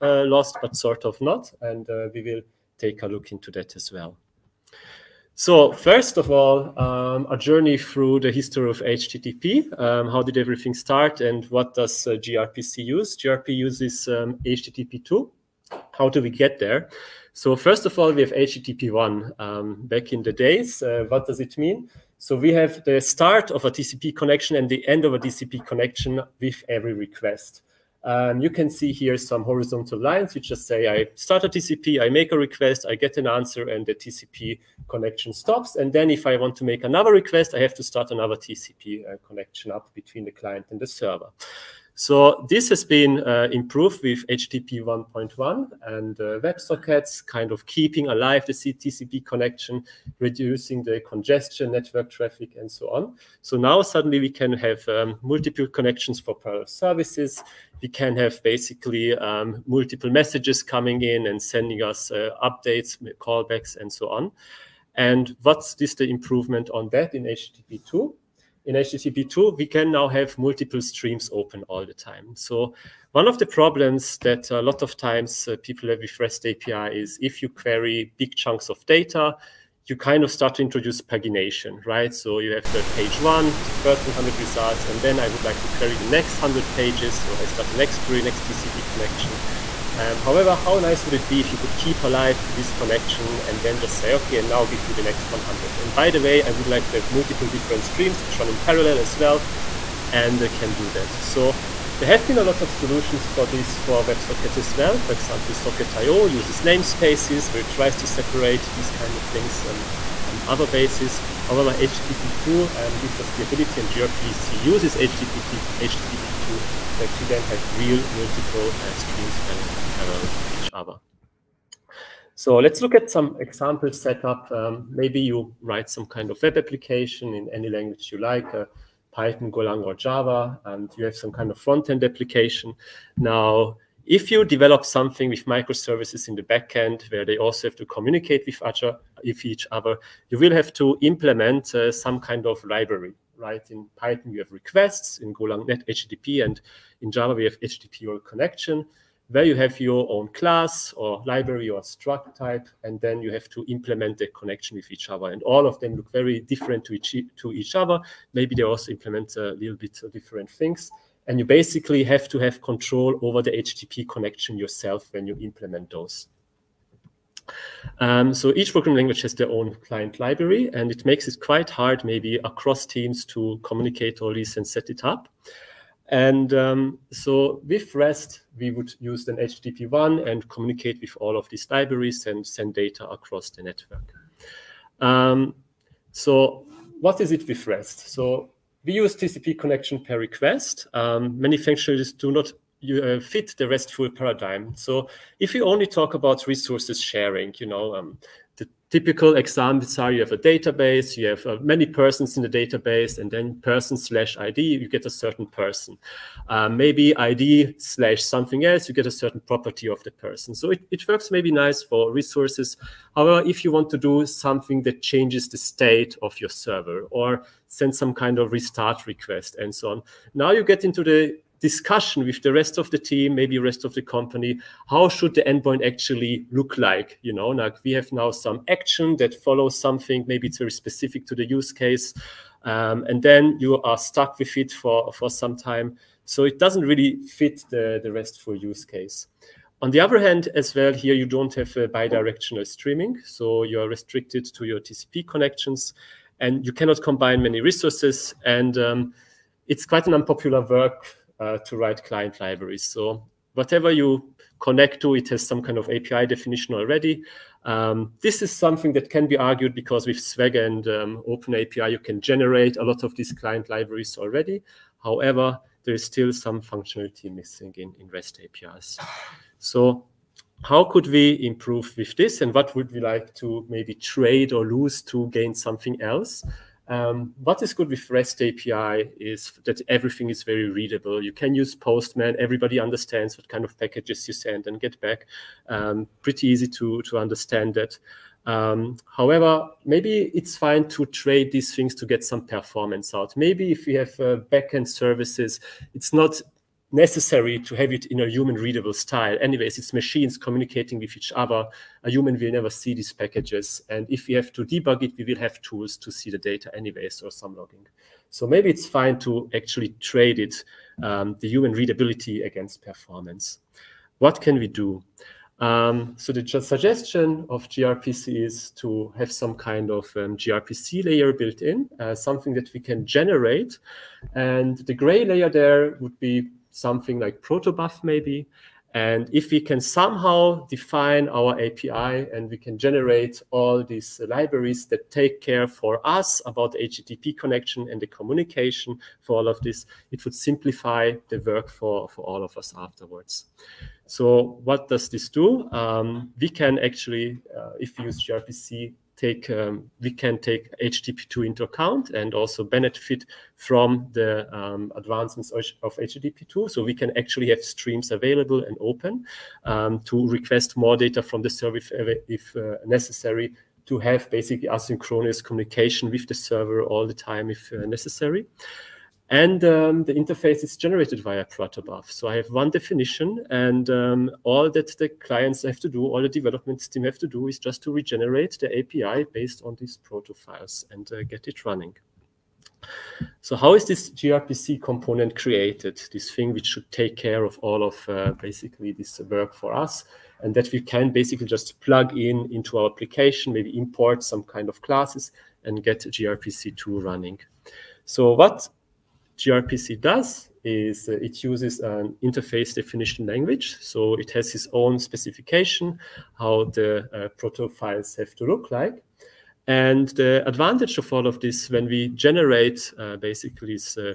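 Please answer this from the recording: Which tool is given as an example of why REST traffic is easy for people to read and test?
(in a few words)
Postman.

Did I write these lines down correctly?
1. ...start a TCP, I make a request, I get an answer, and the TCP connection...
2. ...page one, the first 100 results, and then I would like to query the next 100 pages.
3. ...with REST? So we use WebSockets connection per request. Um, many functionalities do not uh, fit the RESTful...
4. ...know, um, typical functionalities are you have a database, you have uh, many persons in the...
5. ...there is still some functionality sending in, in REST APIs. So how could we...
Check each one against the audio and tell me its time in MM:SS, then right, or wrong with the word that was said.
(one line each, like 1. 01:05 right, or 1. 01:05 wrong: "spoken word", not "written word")
1. 00:31 right
2. 01:22 right
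3. 03:07 wrong: "TCP", not "WebSockets"
4. 03:17 wrong: "examples", not "functionalities"
5. 04:25 wrong: "missing", not "sending".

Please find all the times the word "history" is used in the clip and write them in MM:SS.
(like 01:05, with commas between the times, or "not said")
00:08.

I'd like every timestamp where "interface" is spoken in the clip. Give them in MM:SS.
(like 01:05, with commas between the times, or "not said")
06:10, 06:42.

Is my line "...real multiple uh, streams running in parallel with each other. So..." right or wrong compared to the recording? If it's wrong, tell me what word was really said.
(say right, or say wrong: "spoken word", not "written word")
right.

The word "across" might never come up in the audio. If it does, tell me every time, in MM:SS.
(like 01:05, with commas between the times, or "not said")
02:52, 03:03.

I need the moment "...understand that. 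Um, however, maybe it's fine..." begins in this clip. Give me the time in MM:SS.
04:47.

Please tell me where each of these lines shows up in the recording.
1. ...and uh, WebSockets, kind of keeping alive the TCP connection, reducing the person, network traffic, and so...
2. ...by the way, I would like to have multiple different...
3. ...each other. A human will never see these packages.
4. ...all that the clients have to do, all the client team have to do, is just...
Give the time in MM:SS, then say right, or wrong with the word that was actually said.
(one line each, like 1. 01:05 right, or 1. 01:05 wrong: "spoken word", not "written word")
1. 00:45 wrong: "congestion", not "person"
2. 01:35 right
3. 05:01 right
4. 06:14 wrong: "development", not "client".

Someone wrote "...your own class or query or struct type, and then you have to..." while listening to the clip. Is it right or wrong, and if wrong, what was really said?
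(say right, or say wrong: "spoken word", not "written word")
wrong: "library", not "query".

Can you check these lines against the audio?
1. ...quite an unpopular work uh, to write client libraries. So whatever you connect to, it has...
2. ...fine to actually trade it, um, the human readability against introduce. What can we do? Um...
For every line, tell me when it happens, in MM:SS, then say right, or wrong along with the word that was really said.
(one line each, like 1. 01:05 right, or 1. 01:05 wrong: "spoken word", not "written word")
1. 04:09 right
2. 05:08 wrong: "performance", not "introduce".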